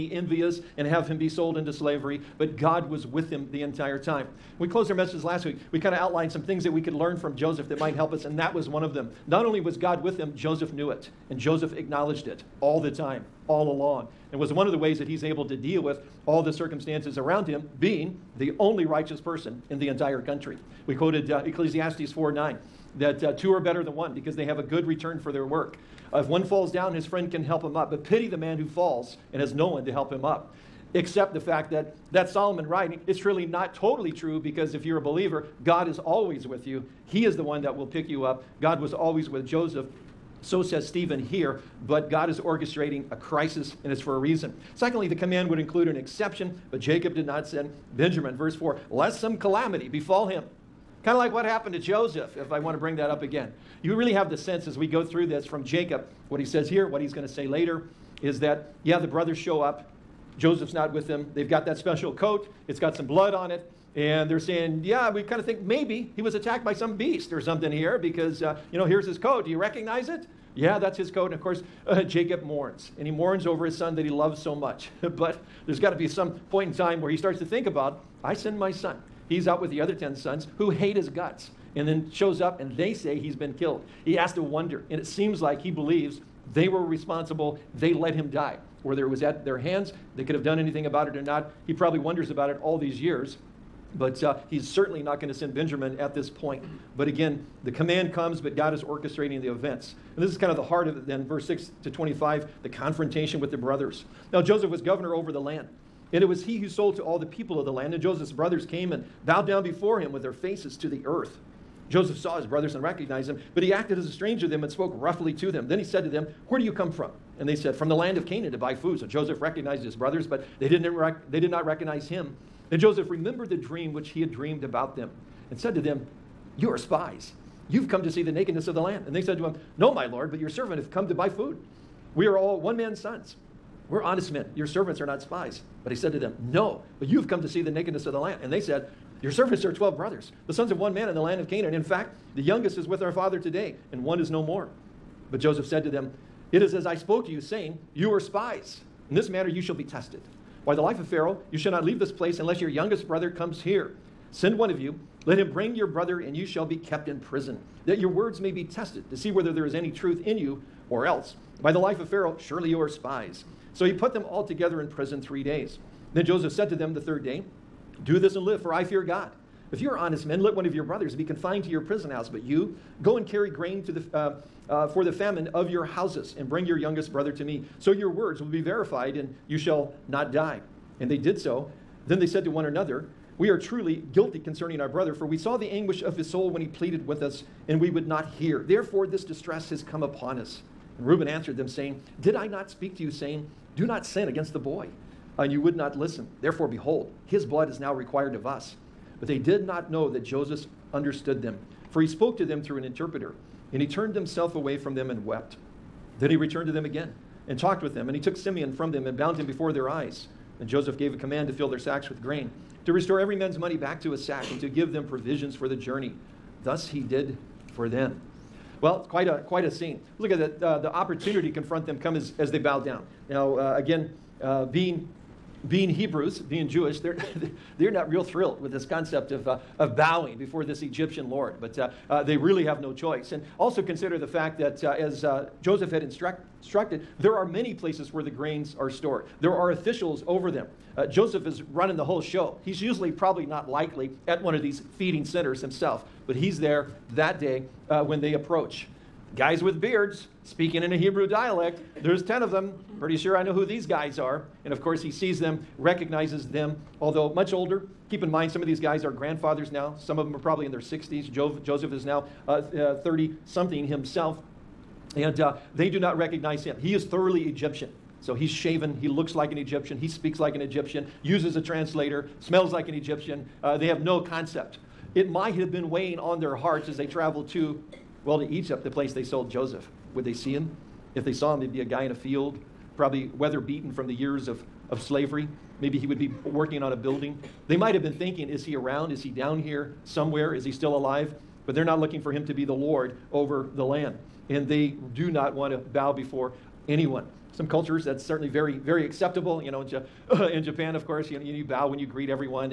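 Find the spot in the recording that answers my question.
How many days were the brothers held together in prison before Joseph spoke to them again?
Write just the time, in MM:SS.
02:45.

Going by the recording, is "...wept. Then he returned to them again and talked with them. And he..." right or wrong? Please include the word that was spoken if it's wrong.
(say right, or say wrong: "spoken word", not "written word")
right.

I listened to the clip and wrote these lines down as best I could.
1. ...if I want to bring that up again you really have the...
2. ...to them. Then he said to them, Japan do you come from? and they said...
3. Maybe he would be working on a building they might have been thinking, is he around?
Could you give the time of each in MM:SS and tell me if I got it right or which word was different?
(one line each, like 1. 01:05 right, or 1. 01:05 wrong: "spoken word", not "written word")
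1. 00:52 right
2. 01:55 wrong: "Where", not "Japan"
3. 04:45 right.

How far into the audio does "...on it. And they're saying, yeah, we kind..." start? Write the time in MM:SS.
01:03.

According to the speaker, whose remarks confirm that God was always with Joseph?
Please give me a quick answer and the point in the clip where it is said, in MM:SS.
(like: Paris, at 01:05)
Stephen, at 00:40.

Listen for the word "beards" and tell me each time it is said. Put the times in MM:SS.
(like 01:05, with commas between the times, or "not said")
04:09.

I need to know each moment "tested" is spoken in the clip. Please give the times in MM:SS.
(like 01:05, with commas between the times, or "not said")
02:29, 02:38.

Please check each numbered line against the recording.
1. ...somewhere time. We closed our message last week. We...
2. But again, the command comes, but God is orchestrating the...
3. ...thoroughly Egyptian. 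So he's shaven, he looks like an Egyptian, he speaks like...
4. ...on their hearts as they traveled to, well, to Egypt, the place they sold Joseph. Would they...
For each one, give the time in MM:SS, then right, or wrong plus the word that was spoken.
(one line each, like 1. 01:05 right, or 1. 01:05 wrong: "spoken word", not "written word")
1. 00:03 wrong: "entire", not "somewhere"
2. 01:36 right
3. 04:27 right
4. 04:36 right.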